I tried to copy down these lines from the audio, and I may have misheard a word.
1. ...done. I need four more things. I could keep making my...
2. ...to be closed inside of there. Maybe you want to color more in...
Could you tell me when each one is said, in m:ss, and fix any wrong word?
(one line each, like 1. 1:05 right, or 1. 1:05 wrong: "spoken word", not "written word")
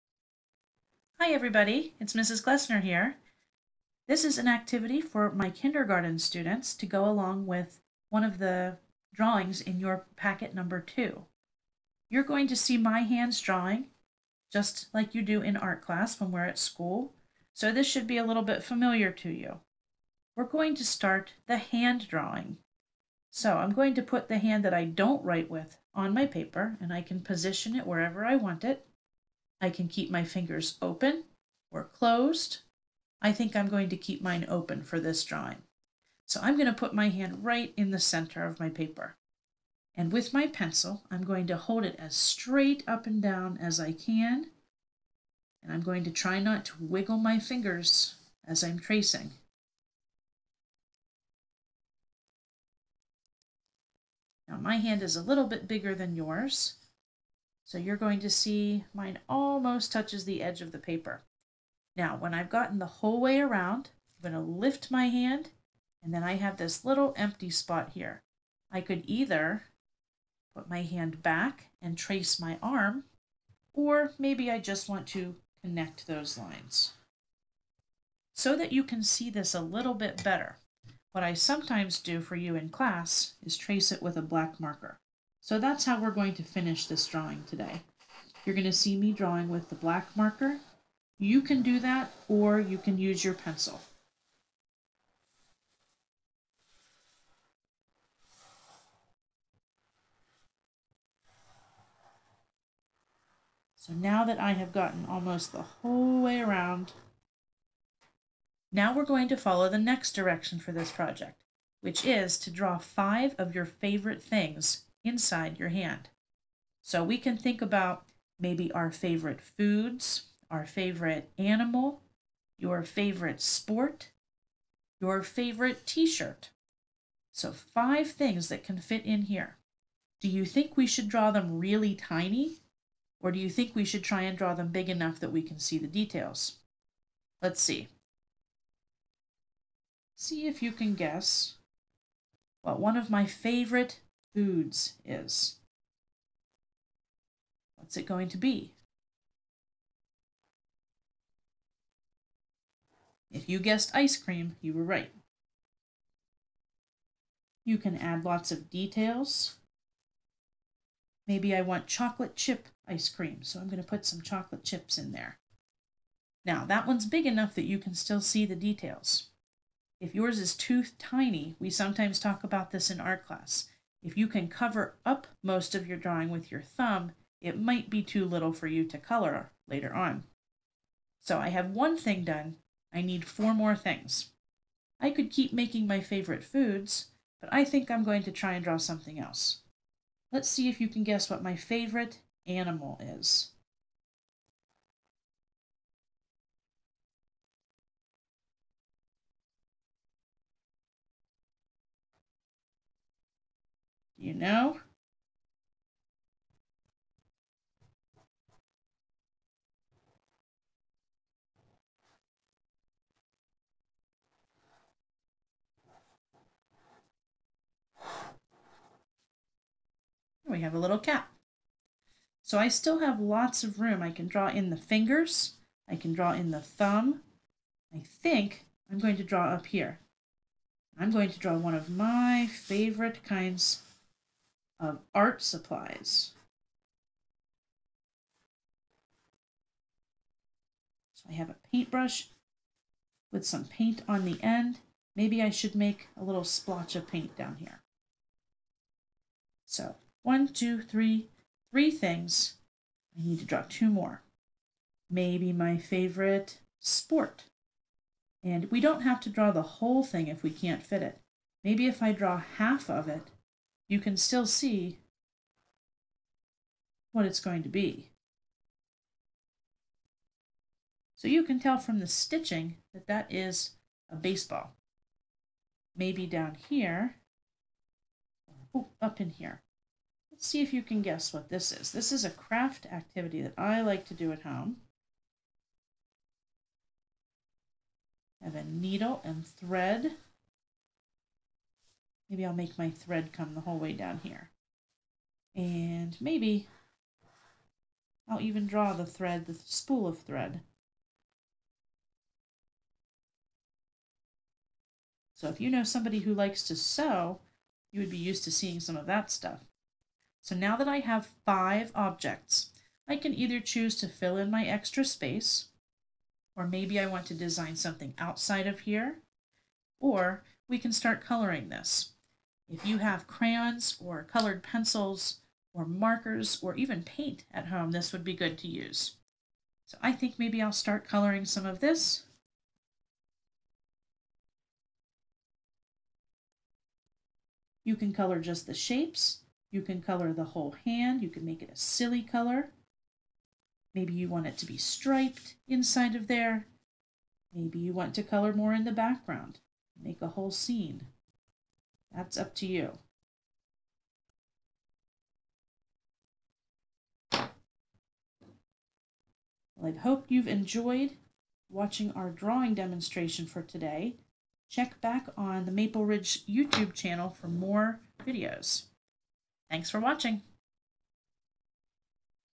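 1. 3:02 right
2. 5:44 wrong: "striped", not "closed".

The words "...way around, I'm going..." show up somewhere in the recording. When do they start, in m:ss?
1:03.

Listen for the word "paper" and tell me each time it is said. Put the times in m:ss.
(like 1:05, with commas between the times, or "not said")
0:26, 0:38, 1:00.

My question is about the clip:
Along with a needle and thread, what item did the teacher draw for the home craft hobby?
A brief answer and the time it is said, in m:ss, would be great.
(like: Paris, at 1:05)
Spool of thread, at 4:59.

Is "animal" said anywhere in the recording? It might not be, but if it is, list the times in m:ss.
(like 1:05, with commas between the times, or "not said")
2:01, 3:12.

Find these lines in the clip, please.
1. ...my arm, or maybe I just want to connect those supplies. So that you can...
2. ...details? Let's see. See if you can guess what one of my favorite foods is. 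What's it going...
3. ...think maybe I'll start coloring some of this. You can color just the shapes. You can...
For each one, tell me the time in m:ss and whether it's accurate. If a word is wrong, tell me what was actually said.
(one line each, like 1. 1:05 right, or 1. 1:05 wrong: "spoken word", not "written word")
1. 1:12 wrong: "lines", not "supplies"
2. 2:15 right
3. 5:30 right.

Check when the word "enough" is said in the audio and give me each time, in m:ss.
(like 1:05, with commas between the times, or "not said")
2:14, 2:47.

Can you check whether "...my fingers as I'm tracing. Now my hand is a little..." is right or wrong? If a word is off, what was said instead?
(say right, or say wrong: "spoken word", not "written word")
right.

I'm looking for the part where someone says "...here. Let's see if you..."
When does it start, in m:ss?
4:39.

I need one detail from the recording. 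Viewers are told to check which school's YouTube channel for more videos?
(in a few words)
Maple Ridge.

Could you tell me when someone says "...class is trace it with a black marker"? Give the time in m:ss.
1:22.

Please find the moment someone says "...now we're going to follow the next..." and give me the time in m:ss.
1:48.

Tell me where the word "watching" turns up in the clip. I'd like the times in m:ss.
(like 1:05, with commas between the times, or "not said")
6:01, 6:09.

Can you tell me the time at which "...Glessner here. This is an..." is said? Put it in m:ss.
0:02.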